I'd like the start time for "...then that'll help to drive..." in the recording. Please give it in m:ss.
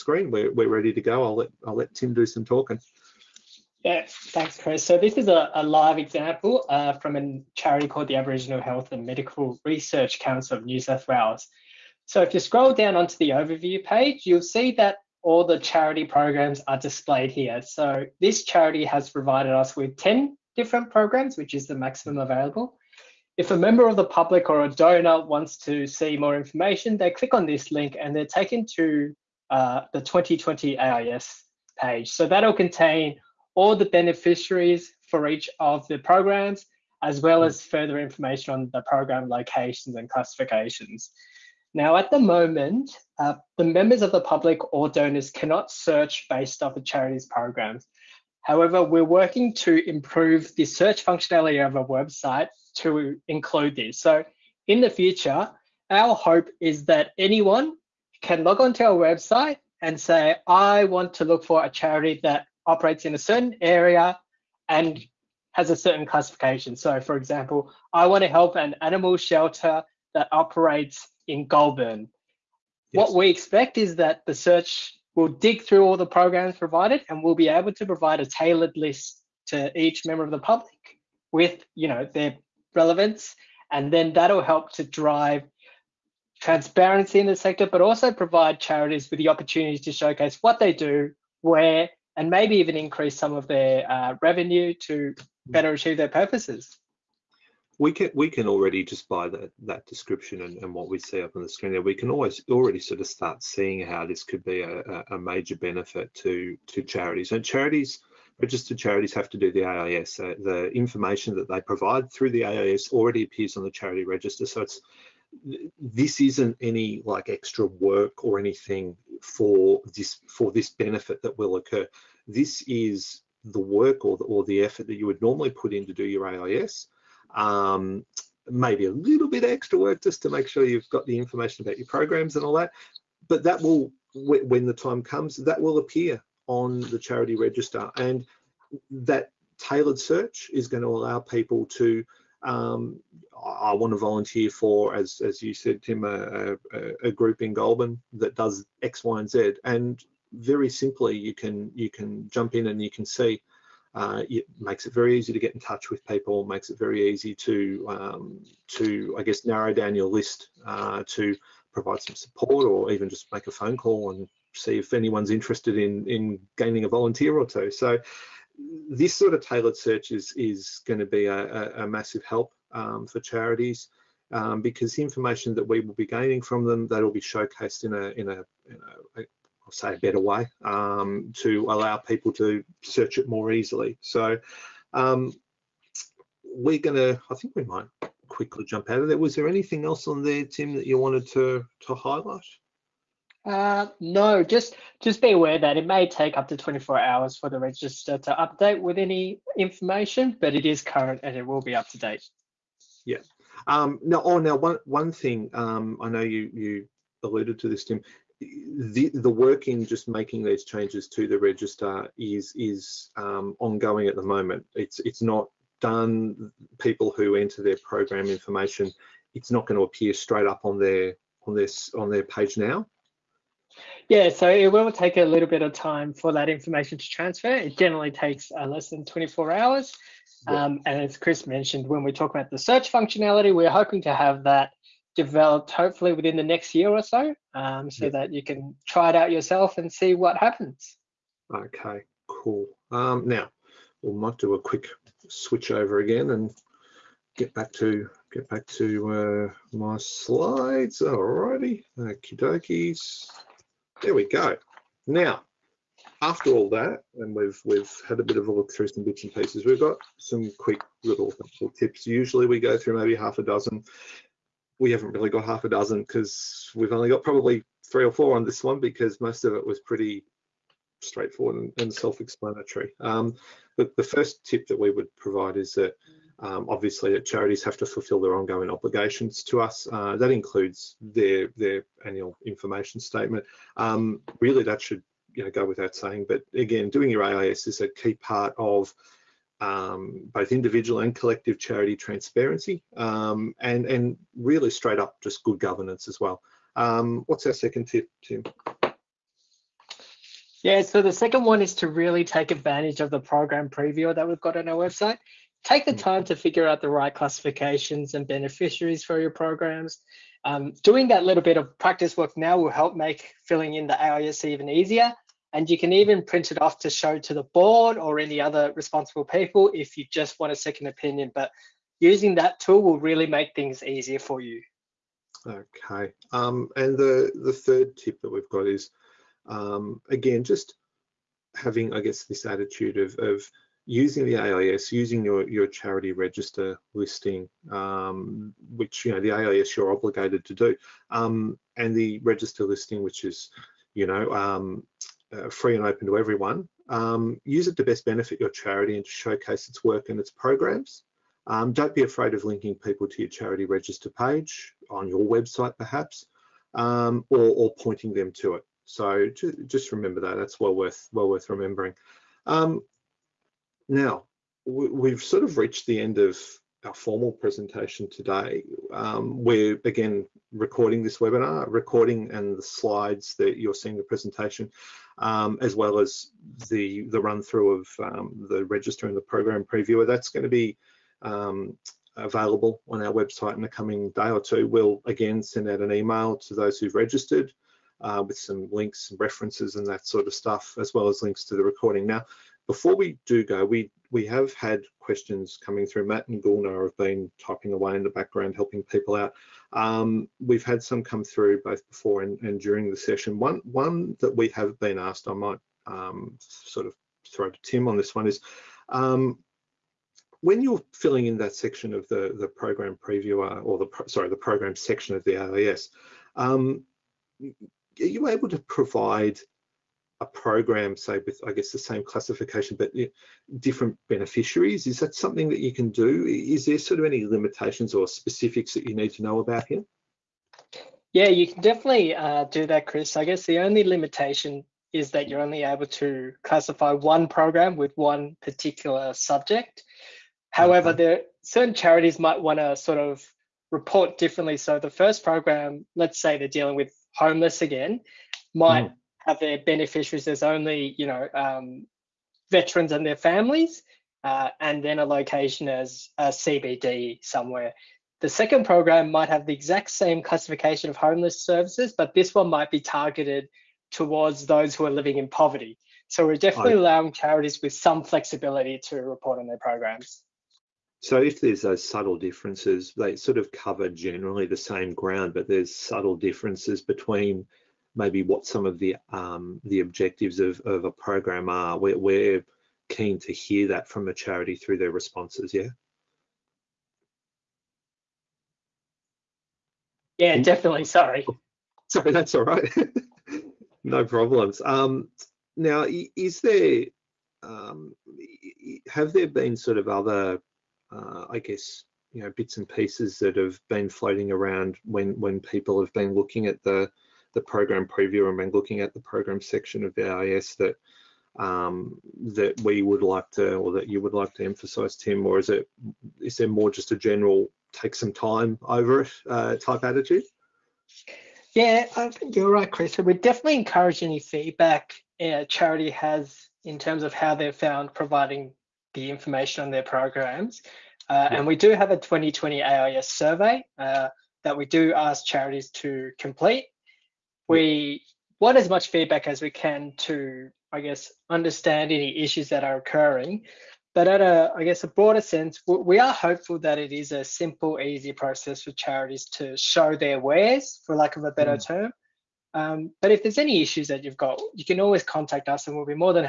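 1:23.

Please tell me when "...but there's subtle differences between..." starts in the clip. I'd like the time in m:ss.
7:55.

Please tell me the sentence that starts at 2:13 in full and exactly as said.
But that will, when the time comes, that will appear on the charity register.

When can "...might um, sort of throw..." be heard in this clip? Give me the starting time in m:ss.
6:45.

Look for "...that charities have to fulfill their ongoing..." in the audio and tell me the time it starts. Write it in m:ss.
4:37.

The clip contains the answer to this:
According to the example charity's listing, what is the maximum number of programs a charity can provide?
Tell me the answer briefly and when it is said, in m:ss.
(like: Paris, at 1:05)
10, at 0:19.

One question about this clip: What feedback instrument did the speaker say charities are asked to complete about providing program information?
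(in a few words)
2020 AIS survey.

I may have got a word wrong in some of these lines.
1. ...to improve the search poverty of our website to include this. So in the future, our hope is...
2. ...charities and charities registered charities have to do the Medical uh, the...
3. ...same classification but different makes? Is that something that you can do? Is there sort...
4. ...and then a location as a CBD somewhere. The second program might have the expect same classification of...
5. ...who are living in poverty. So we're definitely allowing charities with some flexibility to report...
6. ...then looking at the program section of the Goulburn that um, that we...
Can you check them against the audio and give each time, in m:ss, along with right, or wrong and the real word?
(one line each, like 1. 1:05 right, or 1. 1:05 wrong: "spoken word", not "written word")
1. 0:49 wrong: "functionality", not "poverty"
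2. 1:46 wrong: "AIS", not "Medical"
3. 7:01 wrong: "beneficiaries", not "makes"
4. 7:34 wrong: "exact", not "expect"
5. 7:44 right
6. 8:28 wrong: "AIS", not "Goulburn".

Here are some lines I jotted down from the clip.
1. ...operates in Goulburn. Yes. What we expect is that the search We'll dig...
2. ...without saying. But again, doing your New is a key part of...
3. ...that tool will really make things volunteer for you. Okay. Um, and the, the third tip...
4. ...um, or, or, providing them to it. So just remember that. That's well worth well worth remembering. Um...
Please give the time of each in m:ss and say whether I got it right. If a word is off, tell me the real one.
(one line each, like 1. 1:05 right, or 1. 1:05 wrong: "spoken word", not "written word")
1. 1:10 right
2. 4:45 wrong: "AIS", not "New"
3. 5:22 wrong: "easier", not "volunteer"
4. 5:56 wrong: "pointing", not "providing".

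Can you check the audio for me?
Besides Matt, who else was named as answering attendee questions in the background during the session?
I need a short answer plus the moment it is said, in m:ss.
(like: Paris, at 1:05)
Gulnar, at 6:36.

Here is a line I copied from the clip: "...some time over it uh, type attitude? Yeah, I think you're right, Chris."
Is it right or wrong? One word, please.
right.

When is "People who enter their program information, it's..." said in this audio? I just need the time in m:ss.
3:36.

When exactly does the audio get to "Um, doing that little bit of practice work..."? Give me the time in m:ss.
5:10.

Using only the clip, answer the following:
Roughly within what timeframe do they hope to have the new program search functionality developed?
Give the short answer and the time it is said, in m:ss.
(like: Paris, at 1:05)
within the next year, at 3:56.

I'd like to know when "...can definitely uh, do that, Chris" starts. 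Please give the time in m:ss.
7:11.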